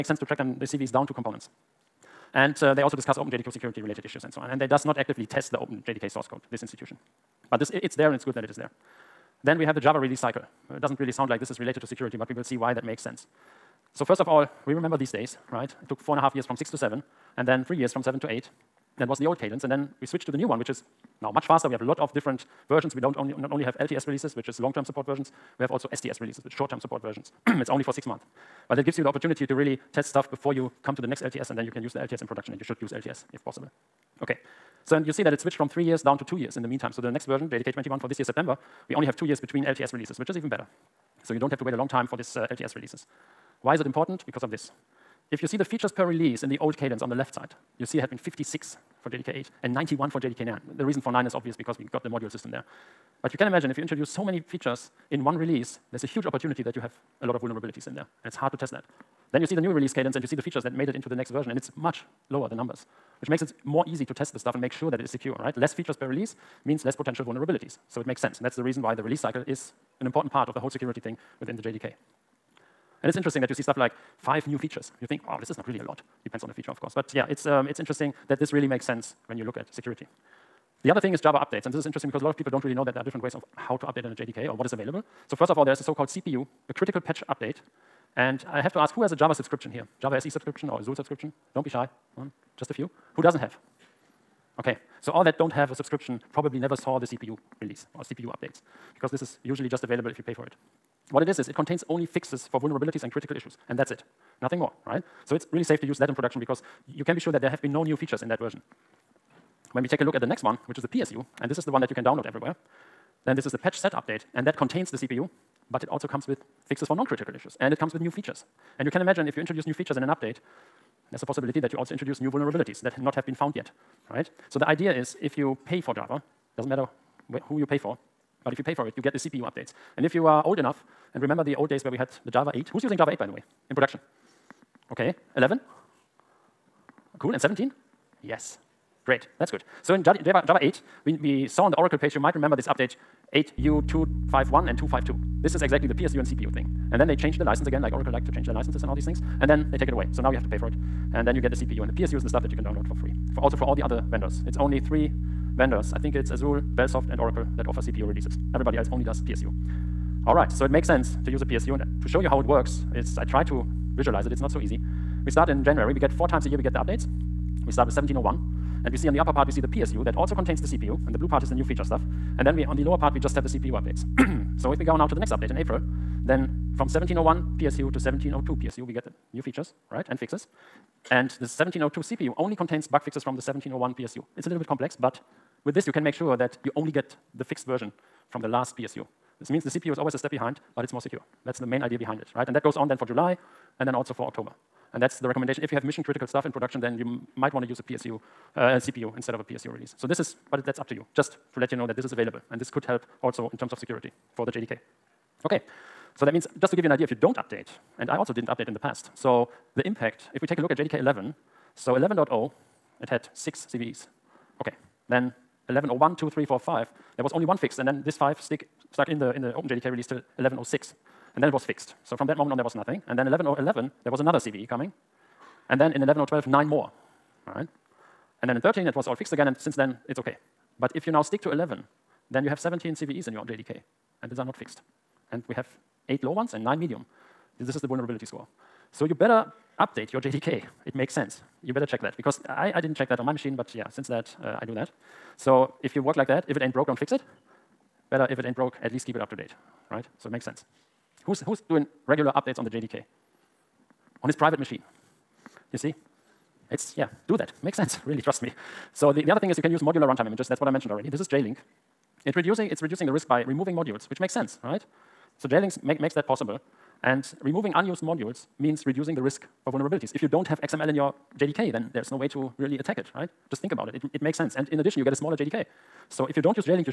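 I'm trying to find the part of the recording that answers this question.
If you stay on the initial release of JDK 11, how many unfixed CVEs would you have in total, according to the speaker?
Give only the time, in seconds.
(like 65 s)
232 s.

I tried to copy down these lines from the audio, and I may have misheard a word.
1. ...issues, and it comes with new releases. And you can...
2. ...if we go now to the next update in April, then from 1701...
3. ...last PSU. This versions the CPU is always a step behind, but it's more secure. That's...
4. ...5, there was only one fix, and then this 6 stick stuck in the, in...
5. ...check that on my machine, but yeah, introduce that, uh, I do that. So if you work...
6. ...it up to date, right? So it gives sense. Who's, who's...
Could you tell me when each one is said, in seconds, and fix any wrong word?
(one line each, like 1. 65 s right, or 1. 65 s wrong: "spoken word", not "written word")
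1. 117 s wrong: "features", not "releases"
2. 174 s right
3. 188 s wrong: "means", not "versions"
4. 216 s wrong: "5", not "6"
5. 242 s wrong: "since", not "introduce"
6. 249 s wrong: "makes", not "gives".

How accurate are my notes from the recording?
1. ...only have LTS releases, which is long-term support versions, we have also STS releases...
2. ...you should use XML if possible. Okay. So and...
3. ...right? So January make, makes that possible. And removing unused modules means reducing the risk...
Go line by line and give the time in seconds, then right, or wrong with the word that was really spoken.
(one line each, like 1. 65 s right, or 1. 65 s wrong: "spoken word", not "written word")
1. 23 s right
2. 32 s wrong: "LTS", not "XML"
3. 264 s wrong: "JLinks", not "January".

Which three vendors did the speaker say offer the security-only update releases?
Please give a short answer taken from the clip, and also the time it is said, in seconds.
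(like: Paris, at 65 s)
Azul, Bellsoft, and Oracle, at 156 s.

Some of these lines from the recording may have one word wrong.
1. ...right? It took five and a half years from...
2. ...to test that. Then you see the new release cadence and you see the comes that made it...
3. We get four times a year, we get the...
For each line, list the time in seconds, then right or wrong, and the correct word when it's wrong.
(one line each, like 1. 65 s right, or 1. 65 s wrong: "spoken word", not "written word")
1. 15 s wrong: "four", not "five"
2. 58 s wrong: "features", not "comes"
3. 165 s right.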